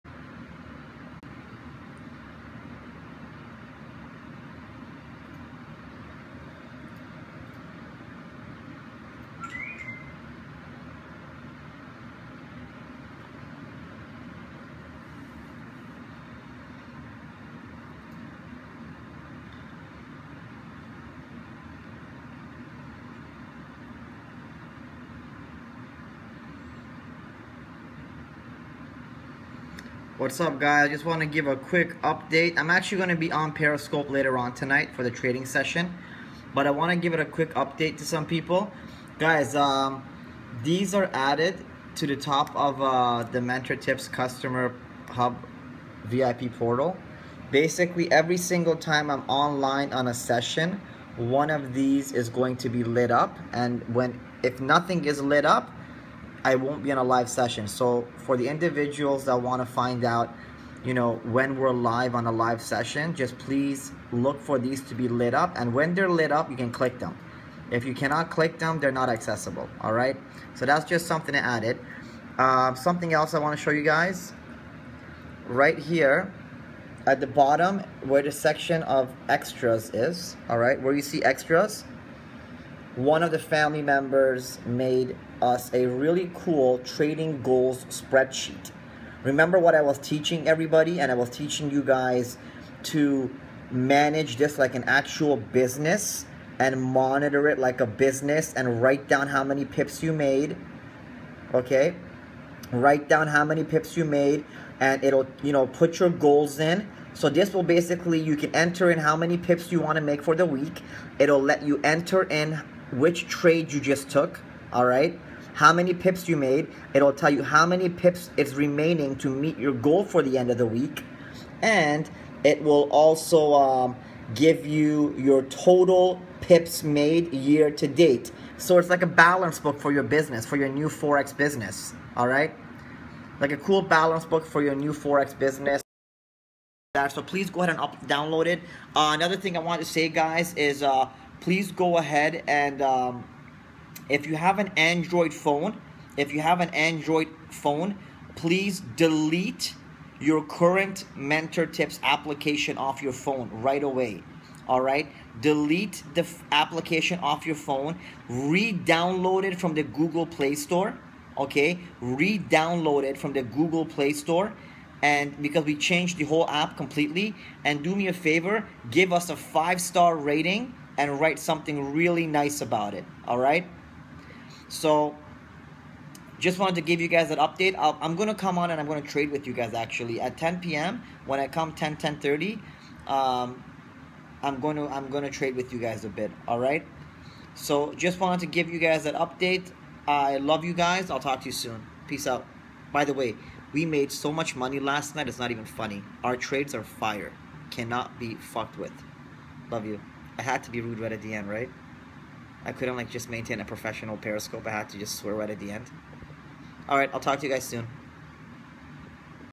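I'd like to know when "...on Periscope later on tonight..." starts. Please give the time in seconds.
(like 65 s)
33 s.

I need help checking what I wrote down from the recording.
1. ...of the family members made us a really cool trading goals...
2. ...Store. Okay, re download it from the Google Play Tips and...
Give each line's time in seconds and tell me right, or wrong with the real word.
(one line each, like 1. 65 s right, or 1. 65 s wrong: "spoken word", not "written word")
1. 83 s right
2. 160 s wrong: "Store", not "Tips".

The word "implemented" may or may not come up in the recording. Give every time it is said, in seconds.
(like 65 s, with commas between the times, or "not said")
not said.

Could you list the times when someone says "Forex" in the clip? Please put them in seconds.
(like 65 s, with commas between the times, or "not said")
130 s, 134 s.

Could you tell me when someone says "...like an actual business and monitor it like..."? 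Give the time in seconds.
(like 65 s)
94 s.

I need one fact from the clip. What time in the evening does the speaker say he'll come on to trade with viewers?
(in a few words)
10 p.m.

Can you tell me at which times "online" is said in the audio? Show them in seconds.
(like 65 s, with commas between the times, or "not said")
49 s.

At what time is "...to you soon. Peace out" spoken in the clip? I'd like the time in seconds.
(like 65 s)
191 s.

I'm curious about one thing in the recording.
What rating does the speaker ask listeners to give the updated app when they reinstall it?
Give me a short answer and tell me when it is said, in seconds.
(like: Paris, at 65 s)
Five star, at 169 s.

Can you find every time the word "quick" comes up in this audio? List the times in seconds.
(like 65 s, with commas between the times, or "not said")
31 s, 37 s.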